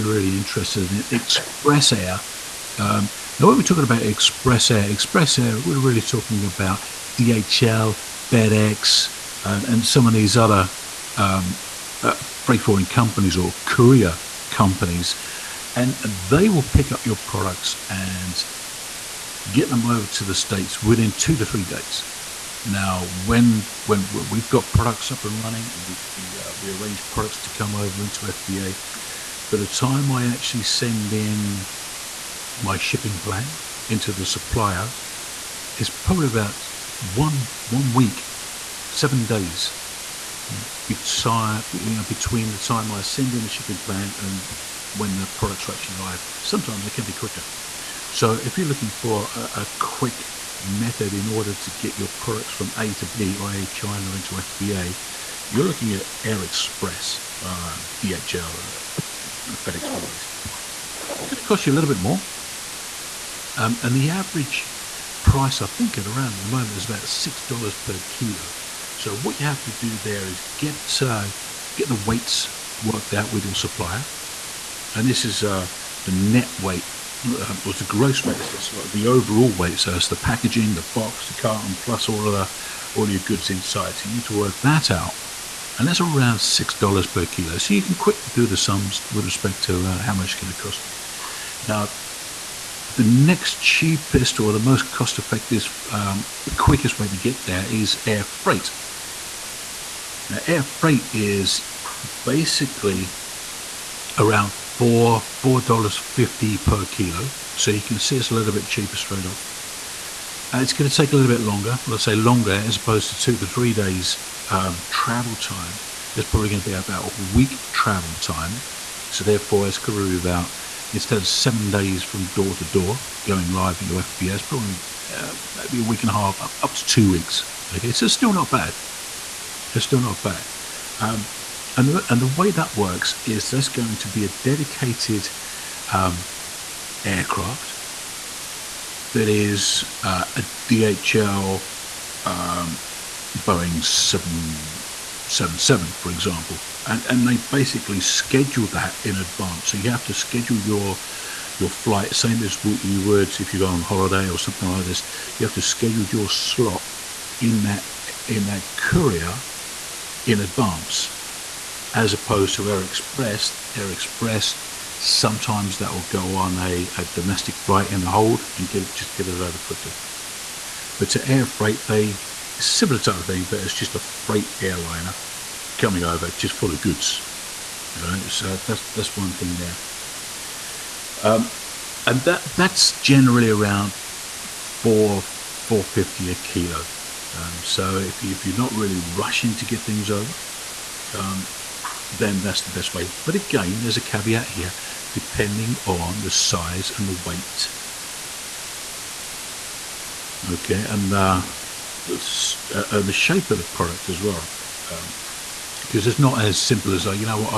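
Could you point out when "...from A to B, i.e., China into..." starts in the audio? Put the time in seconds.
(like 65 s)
52 s.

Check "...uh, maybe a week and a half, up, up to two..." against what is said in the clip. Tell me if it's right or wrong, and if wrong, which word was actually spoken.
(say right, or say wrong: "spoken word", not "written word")
right.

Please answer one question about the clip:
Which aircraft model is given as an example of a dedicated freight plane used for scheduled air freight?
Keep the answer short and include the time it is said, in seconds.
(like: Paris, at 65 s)
Boeing 777, at 143 s.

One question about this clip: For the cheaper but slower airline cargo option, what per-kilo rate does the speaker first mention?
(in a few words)
$4.50 per kilo.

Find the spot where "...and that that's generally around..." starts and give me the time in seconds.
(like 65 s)
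182 s.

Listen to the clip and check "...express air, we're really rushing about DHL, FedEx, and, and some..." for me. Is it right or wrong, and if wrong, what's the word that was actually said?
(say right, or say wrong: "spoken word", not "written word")
wrong: "talking", not "rushing".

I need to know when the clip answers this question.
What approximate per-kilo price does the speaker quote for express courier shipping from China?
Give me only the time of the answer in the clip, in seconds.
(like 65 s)
67 s.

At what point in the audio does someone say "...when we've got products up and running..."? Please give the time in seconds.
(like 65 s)
23 s.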